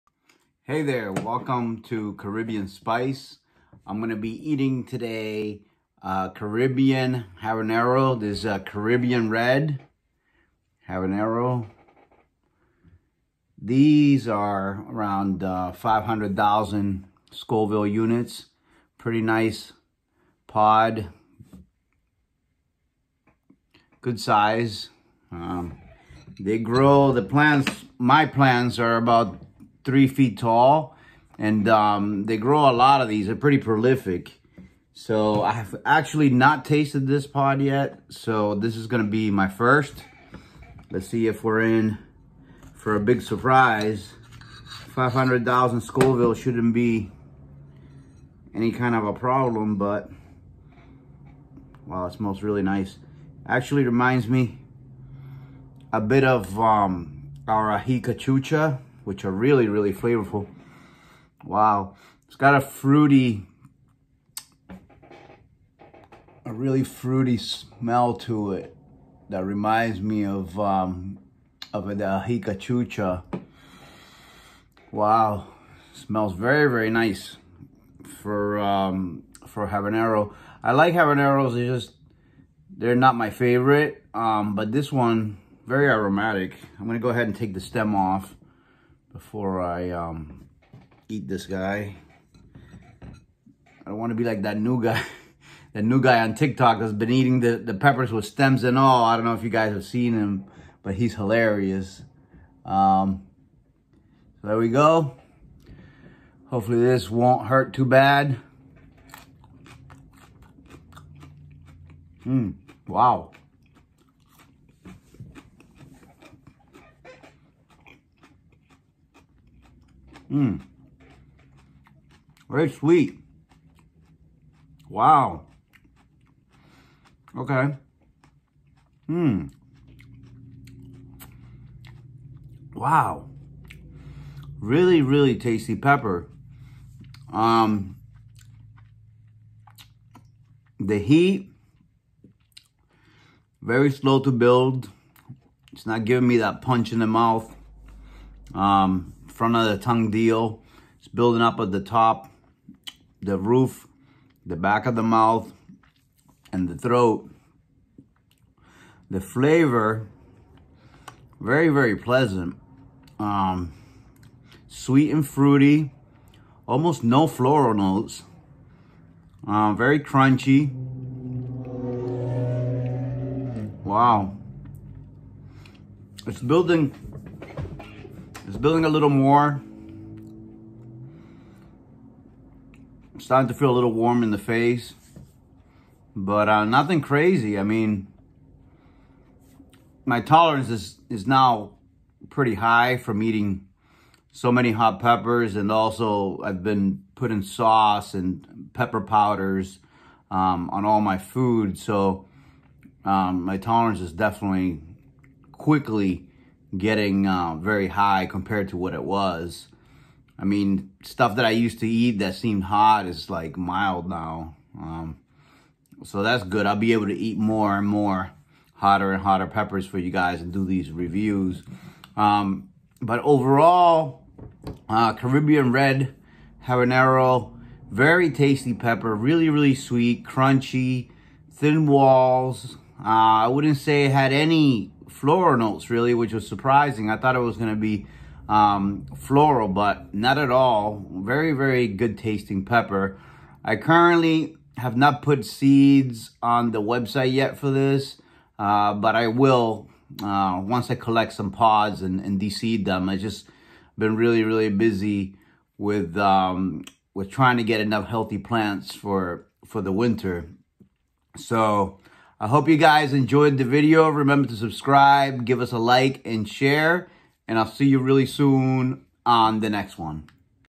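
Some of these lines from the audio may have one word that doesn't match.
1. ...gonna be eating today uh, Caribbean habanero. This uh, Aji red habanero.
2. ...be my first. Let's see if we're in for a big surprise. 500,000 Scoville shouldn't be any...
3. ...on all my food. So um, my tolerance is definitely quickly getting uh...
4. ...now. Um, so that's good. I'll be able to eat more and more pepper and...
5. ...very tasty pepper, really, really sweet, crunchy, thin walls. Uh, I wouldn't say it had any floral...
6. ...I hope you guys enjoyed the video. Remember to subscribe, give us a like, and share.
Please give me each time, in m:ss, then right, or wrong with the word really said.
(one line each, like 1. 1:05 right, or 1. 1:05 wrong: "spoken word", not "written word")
1. 0:03 wrong: "Caribbean", not "Aji"
2. 0:39 right
3. 3:20 right
4. 3:34 wrong: "hotter", not "pepper"
5. 3:47 right
6. 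4:22 right.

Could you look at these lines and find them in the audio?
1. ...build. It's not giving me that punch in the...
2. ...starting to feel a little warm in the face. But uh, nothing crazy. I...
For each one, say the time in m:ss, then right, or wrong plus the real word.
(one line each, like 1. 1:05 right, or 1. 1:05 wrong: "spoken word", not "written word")
1. 2:24 right
2. 3:03 right.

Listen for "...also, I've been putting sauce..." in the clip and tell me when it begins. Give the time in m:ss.
3:15.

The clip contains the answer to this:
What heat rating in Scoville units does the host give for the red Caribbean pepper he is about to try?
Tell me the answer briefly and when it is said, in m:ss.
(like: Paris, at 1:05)
500,000, at 0:15.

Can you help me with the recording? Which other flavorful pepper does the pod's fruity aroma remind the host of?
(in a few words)
Aji Cachucha.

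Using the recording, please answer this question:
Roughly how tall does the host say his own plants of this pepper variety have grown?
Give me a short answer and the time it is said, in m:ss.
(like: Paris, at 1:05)
3 feet, at 0:29.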